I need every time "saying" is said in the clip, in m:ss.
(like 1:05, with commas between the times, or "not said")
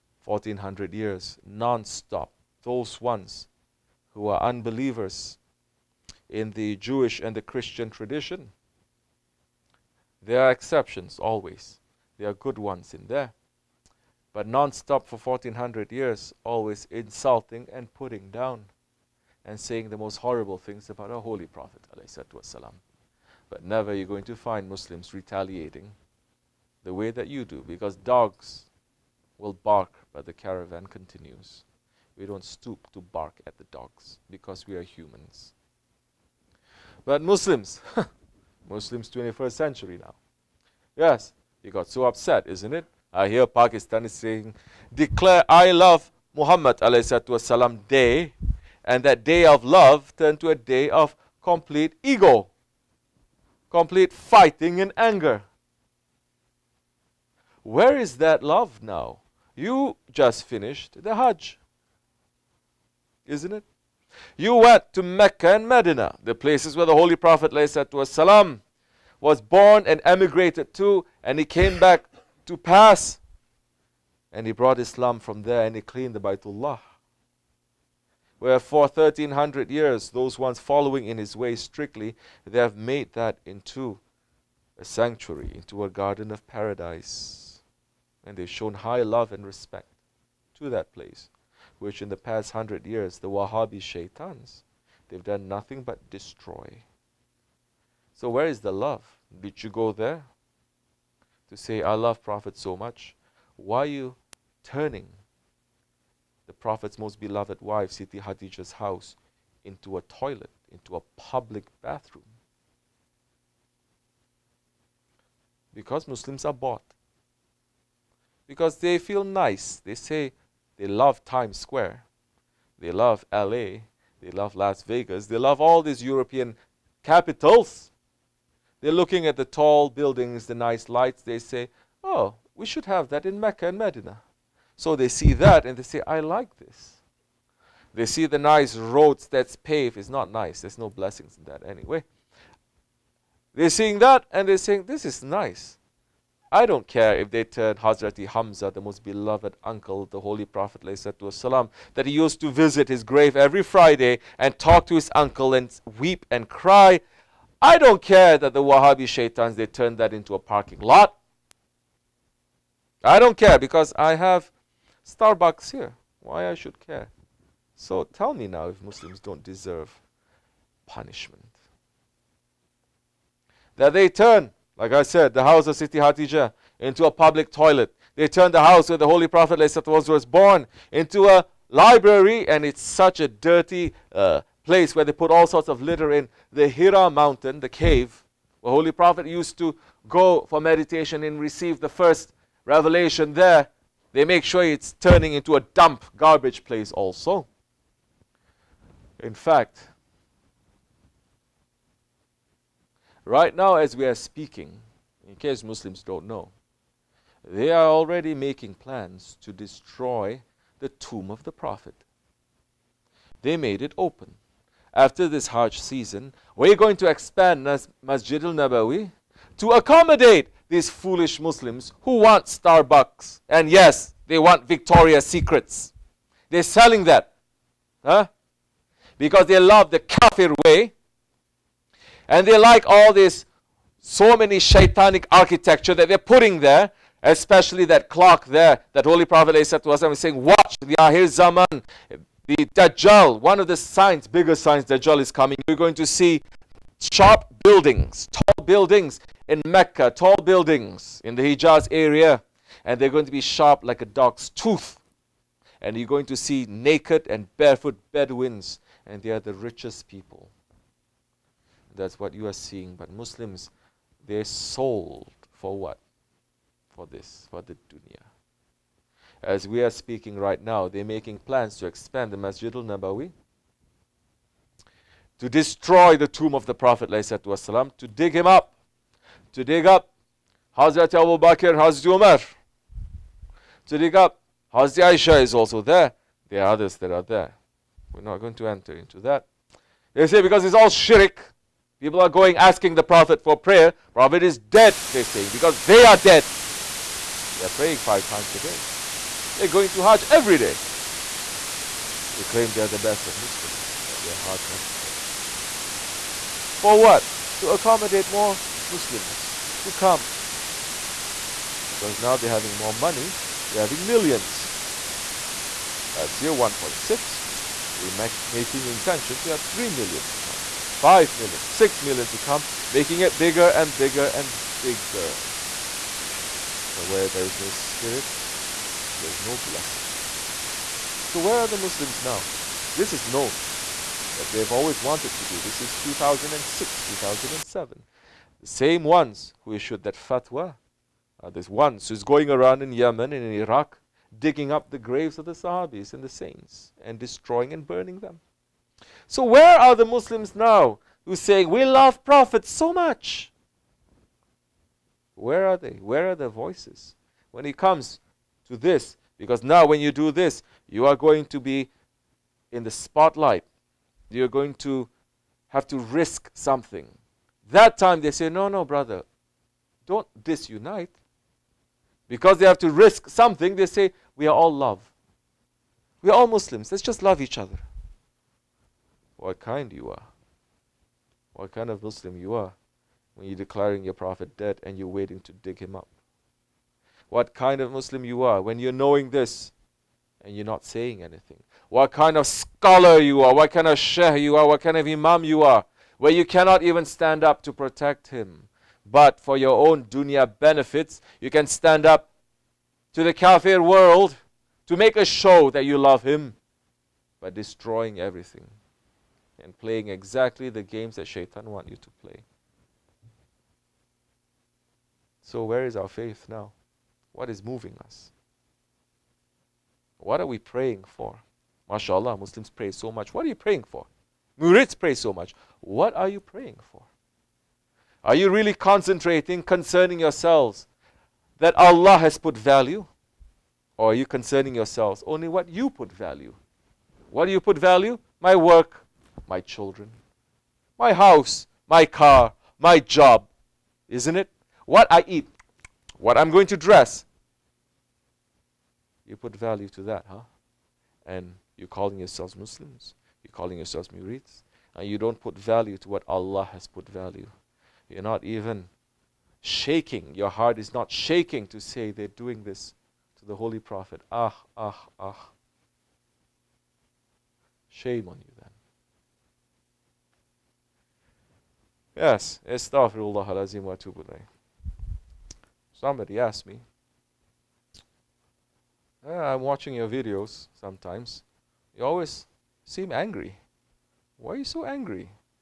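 0:19, 0:44, 2:24, 4:00, 4:55, 6:30.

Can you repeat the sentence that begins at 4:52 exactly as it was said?
People are going asking the Prophet for prayer.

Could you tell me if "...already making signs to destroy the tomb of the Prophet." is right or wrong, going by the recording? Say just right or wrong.
wrong.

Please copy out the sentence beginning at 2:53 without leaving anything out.
That they turn, like I said, the house of Siti Hatija into a public toilet.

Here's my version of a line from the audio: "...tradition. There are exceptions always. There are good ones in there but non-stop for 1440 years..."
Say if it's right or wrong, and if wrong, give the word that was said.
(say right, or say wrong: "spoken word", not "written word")
wrong: "1400", not "1440".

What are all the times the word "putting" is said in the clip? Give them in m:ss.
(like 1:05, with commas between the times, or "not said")
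0:17, 3:56.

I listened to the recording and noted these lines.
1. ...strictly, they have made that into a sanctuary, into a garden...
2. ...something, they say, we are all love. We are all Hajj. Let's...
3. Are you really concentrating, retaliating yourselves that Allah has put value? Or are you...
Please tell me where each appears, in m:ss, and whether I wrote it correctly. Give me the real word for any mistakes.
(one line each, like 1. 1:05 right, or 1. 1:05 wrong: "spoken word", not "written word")
1. 1:21 right
2. 6:13 wrong: "Muslims", not "Hajj"
3. 7:08 wrong: "concerning", not "retaliating".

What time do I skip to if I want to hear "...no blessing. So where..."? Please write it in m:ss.
5:29.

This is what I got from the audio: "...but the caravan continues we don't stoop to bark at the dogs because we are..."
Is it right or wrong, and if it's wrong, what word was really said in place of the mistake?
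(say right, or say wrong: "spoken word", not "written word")
right.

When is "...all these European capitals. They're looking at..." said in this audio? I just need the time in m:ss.
2:05.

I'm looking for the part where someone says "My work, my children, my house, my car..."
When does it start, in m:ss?
7:18.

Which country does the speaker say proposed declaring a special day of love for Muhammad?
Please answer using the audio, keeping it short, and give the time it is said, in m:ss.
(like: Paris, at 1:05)
Pakistan, at 0:43.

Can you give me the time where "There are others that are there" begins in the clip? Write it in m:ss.
4:46.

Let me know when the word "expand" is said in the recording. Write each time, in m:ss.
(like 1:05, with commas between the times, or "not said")
3:37, 4:31.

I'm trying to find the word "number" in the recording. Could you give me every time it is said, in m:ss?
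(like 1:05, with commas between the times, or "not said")
not said.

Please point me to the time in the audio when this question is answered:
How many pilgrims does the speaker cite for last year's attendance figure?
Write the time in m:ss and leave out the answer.
5:16.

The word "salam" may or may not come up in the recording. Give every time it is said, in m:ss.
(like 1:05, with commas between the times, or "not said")
0:47, 1:08.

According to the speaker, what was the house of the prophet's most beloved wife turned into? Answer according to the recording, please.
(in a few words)
A public bathroom.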